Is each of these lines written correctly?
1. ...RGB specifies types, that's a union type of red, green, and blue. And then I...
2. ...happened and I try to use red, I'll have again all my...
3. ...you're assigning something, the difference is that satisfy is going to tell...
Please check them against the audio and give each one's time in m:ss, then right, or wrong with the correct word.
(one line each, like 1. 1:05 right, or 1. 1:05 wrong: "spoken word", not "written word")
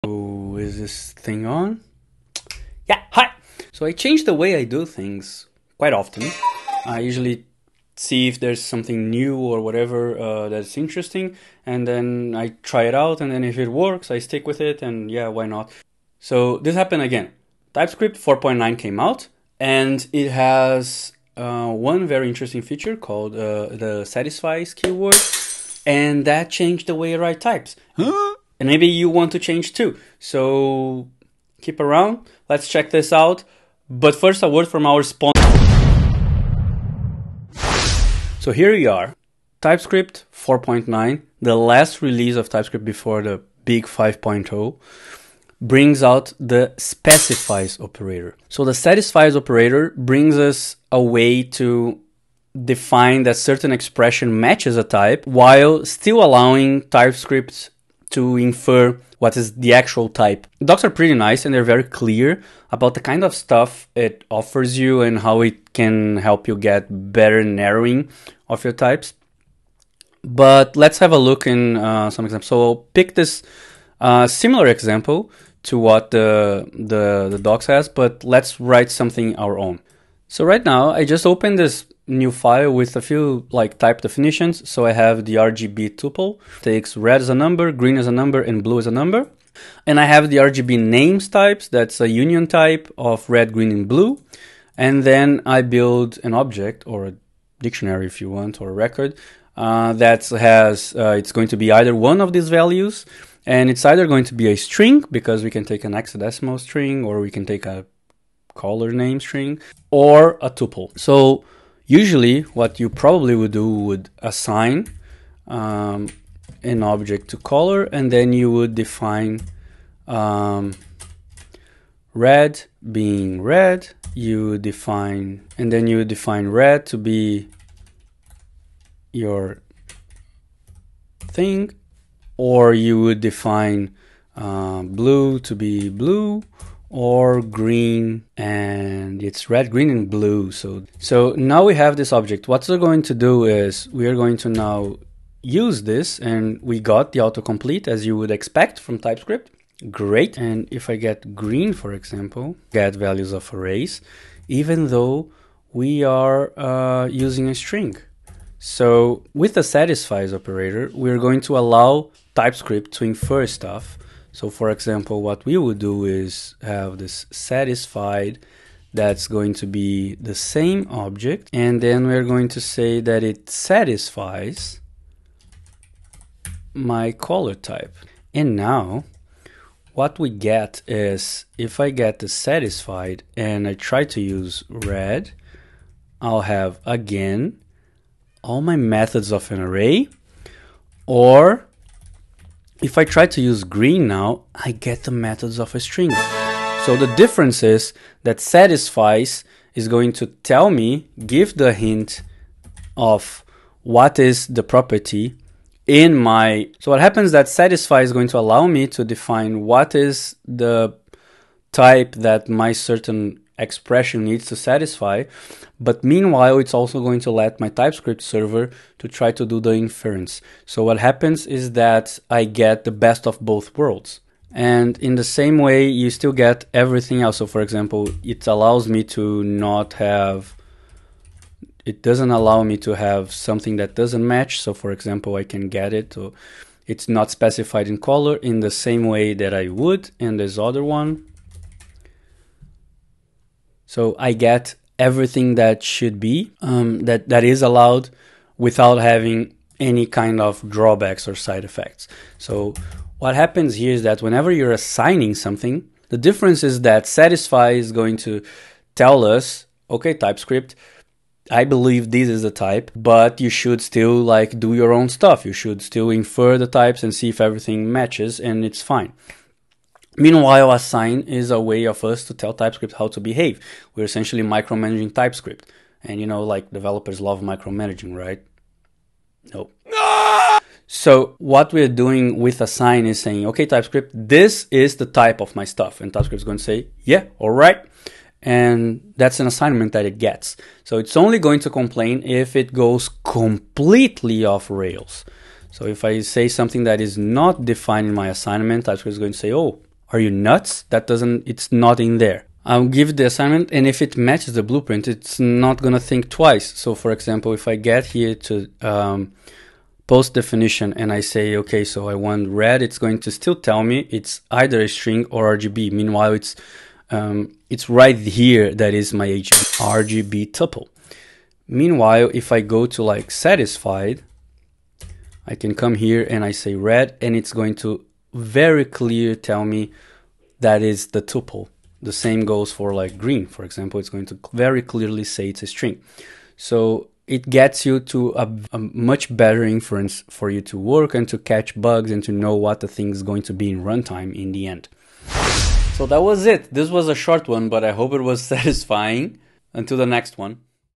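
1. 1:30 wrong: "names", not "specifies"
2. 3:02 wrong: "satisfied", not "happened"
3. 4:14 right.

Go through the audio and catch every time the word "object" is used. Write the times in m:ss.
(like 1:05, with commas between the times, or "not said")
1:36, 1:56, 2:22, 2:50.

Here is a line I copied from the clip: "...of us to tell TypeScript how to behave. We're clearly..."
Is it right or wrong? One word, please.
wrong.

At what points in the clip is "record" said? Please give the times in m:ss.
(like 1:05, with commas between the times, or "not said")
1:38.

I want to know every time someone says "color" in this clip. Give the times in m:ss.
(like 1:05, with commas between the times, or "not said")
1:48, 1:57, 2:57, 3:57.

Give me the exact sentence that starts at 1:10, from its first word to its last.
But let's have a look in uh, some examples.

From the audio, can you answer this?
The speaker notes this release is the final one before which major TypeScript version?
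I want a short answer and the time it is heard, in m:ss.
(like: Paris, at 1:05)
5.0, at 0:43.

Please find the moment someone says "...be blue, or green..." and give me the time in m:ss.
2:15.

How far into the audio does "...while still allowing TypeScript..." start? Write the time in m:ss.
0:55.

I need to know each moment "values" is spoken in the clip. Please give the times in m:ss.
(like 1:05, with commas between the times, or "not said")
1:42, 2:32.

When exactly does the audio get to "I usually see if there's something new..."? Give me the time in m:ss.
0:06.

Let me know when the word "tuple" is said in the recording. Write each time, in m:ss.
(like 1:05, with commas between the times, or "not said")
1:25, 1:50, 5:20, 5:31.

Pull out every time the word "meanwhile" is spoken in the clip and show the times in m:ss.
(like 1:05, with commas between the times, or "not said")
3:36, 4:30, 5:15, 5:21.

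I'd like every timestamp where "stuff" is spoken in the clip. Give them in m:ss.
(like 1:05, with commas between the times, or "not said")
1:03, 2:43, 4:25, 4:45.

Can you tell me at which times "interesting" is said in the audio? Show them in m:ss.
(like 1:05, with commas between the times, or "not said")
0:10, 0:22.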